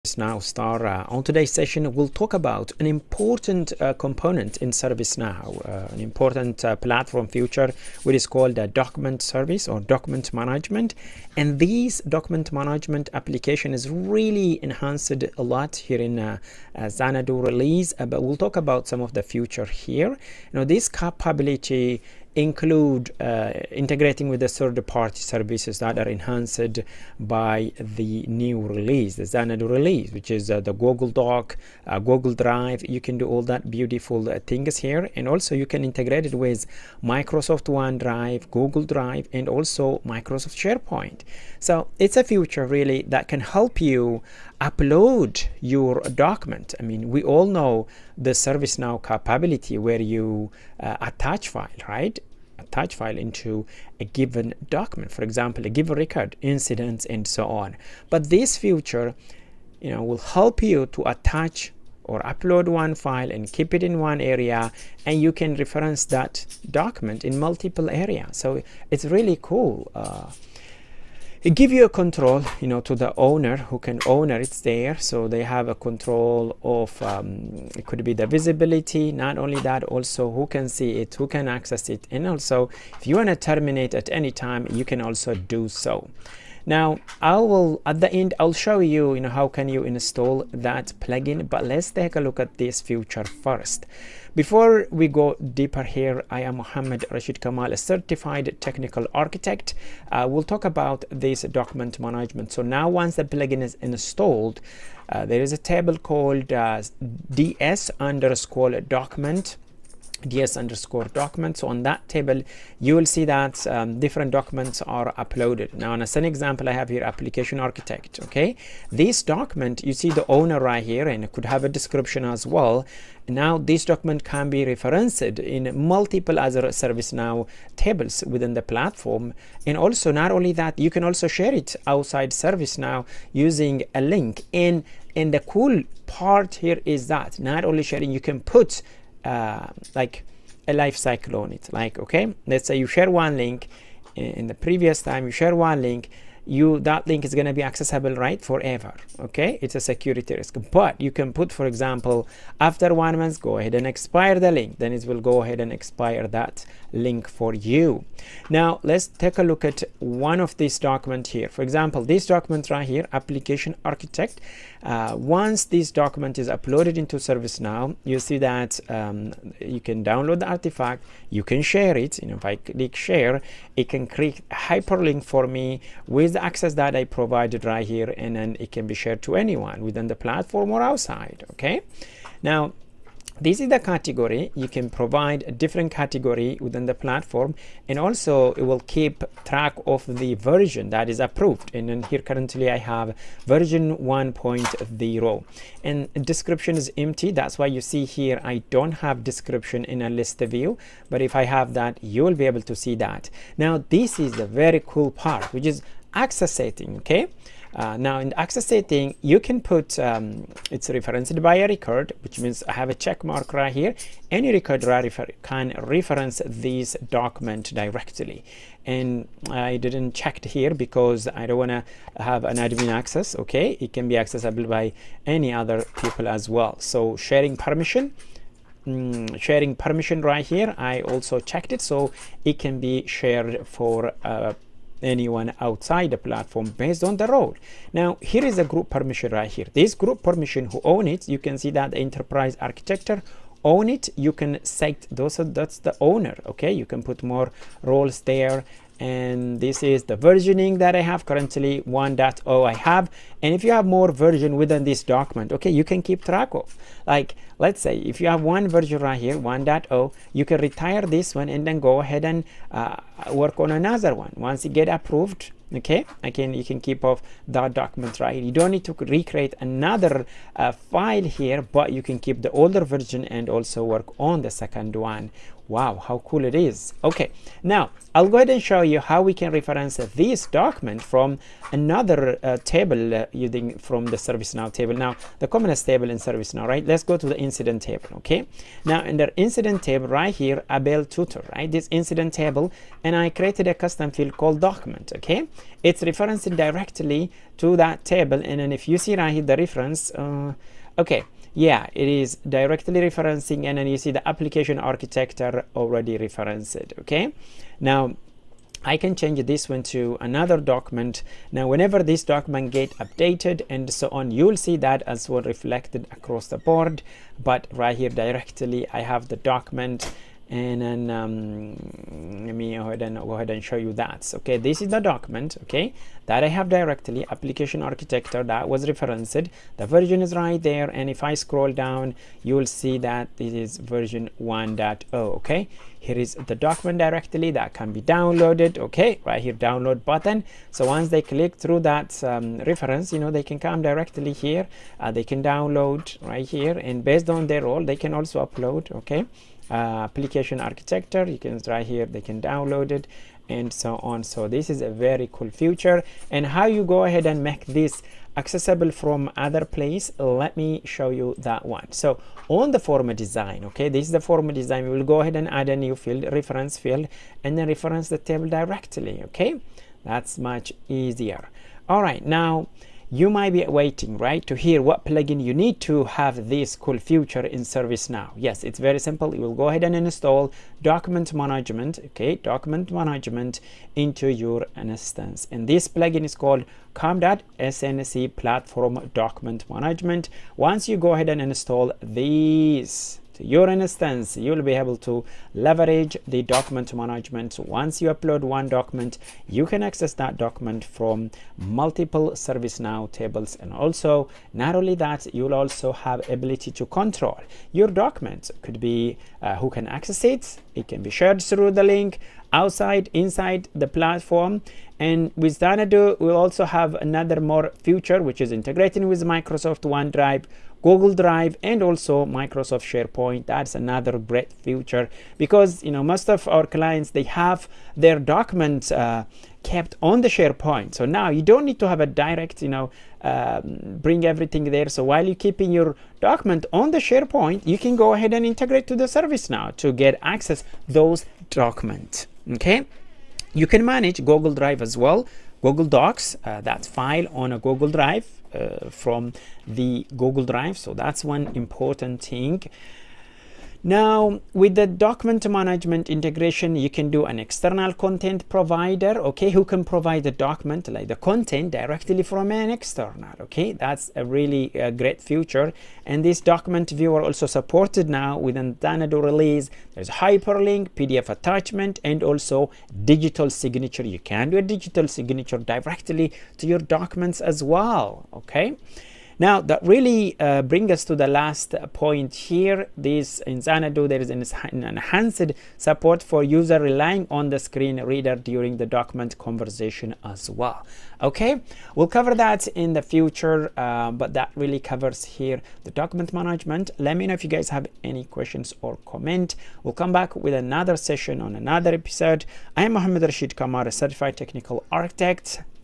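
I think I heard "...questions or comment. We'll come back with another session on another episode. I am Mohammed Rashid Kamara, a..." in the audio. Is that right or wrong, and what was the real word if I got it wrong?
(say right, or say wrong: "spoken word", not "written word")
right.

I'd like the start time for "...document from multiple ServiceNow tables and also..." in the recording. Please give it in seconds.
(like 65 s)
400 s.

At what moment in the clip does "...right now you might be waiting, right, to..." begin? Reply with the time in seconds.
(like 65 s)
372 s.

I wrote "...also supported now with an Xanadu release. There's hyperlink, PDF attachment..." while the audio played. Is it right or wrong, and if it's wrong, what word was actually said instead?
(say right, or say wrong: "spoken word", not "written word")
right.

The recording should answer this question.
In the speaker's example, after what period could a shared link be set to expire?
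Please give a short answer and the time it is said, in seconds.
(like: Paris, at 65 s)
One month, at 152 s.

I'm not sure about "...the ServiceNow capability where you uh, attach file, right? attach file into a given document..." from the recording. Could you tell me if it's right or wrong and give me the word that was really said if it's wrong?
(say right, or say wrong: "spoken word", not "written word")
right.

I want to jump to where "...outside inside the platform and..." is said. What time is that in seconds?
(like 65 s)
412 s.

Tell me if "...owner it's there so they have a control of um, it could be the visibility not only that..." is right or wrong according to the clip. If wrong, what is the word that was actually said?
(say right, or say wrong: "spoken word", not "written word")
right.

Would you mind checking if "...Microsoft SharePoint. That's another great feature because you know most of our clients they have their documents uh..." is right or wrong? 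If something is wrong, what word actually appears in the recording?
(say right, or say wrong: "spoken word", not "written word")
right.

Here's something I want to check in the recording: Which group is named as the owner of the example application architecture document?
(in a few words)
Enterprise architecture.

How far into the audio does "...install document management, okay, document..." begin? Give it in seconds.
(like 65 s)
379 s.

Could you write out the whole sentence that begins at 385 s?
And this plugin is called com.snc platform document management.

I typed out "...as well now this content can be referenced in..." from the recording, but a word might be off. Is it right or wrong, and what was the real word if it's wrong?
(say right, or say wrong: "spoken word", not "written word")
wrong: "document", not "content".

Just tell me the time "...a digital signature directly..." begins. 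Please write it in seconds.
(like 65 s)
474 s.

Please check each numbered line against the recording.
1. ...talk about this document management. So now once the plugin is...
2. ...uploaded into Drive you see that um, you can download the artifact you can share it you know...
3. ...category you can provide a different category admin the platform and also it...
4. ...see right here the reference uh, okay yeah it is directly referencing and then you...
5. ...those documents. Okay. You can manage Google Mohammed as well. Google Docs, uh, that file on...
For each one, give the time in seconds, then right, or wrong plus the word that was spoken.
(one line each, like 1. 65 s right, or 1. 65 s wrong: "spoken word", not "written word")
1. 100 s right
2. 166 s wrong: "ServiceNow", not "Drive"
3. 183 s wrong: "within", not "admin"
4. 298 s right
5. 440 s wrong: "Drive", not "Mohammed".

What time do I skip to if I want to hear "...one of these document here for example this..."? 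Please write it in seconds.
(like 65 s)
159 s.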